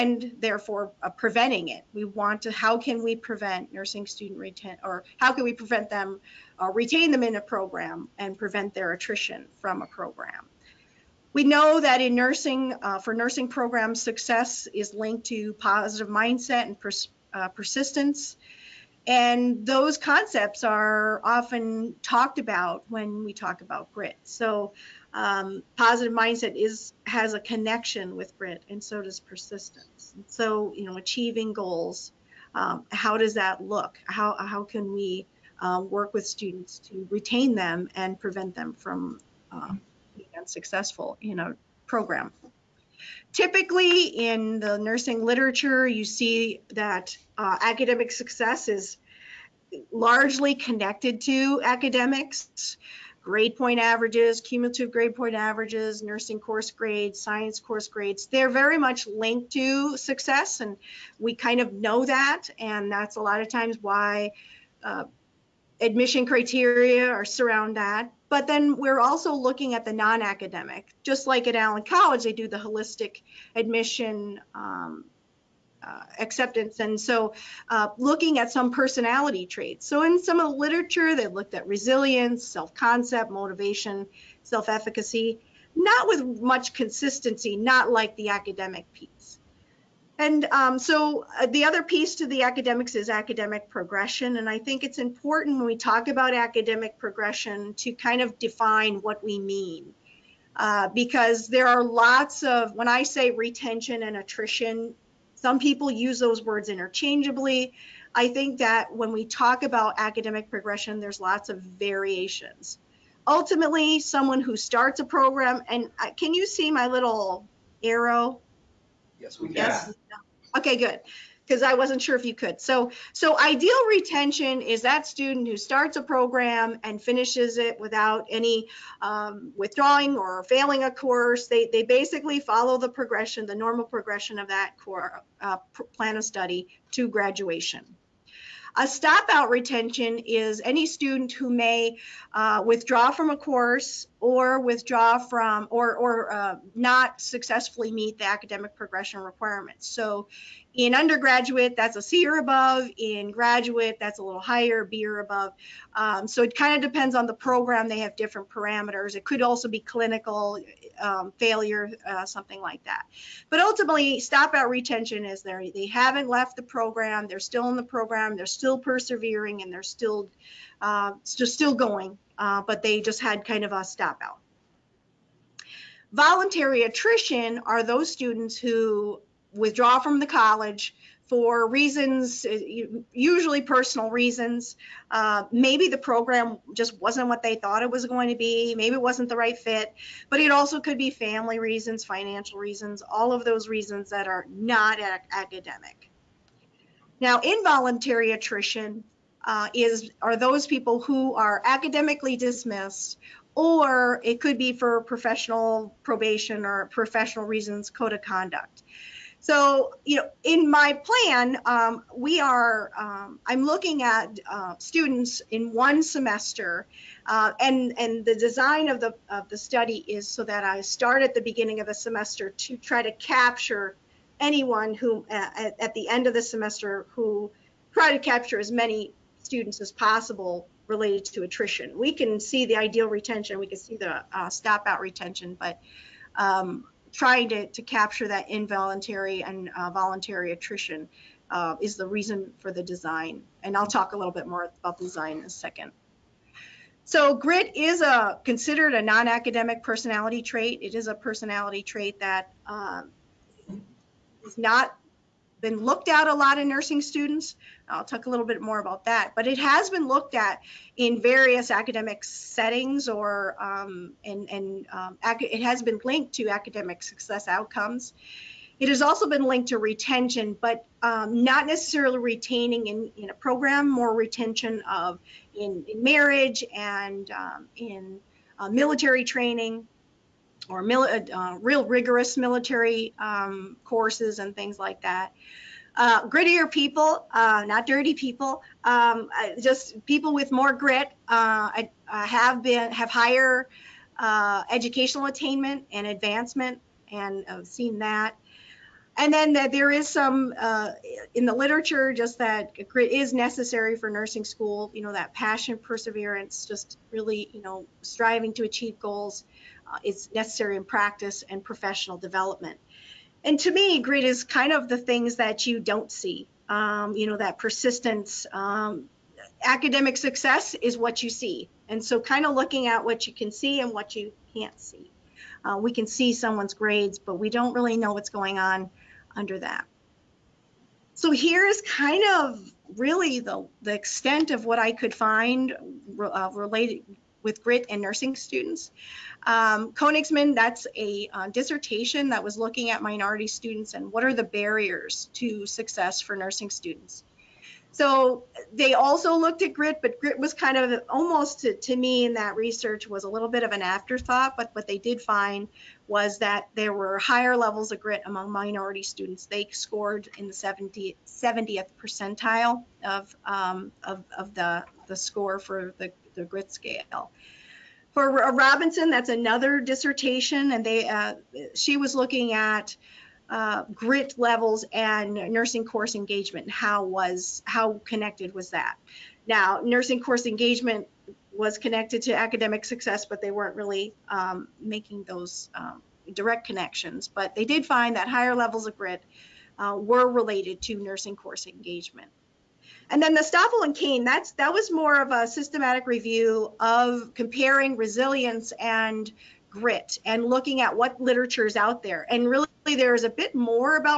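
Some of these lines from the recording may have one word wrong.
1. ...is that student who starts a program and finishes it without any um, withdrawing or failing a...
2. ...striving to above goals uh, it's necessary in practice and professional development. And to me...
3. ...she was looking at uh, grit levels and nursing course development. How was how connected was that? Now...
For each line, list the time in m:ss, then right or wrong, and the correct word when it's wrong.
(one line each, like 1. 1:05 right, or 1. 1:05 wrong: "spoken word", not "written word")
1. 2:04 right
2. 5:08 wrong: "achieve", not "above"
3. 6:11 wrong: "engagement", not "development".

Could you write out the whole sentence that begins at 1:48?
I think that when we talk about academic progression, there's lots of variations.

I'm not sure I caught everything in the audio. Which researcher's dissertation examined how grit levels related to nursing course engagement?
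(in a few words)
Robinson.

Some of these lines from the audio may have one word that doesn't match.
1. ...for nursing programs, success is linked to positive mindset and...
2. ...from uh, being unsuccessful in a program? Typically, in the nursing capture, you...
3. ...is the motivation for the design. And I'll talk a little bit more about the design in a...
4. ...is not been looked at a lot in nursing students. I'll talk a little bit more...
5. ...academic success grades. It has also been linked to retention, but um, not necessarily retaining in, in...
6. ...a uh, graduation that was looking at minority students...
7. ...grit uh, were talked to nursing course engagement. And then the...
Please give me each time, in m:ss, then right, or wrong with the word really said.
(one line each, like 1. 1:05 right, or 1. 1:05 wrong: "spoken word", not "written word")
1. 0:12 right
2. 0:38 wrong: "literature", not "capture"
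3. 4:01 wrong: "reason", not "motivation"
4. 4:14 right
5. 4:26 wrong: "outcomes", not "grades"
6. 5:40 wrong: "dissertation", not "graduation"
7. 6:28 wrong: "related", not "talked".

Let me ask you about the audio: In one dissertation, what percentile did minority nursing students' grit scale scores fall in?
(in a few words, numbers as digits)
70th percentile.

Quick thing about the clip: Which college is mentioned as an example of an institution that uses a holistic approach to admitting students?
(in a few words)
Allen College.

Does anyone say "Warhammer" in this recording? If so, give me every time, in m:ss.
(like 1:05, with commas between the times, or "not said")
not said.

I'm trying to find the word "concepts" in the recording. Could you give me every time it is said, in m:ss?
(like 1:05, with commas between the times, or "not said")
0:19, 1:22.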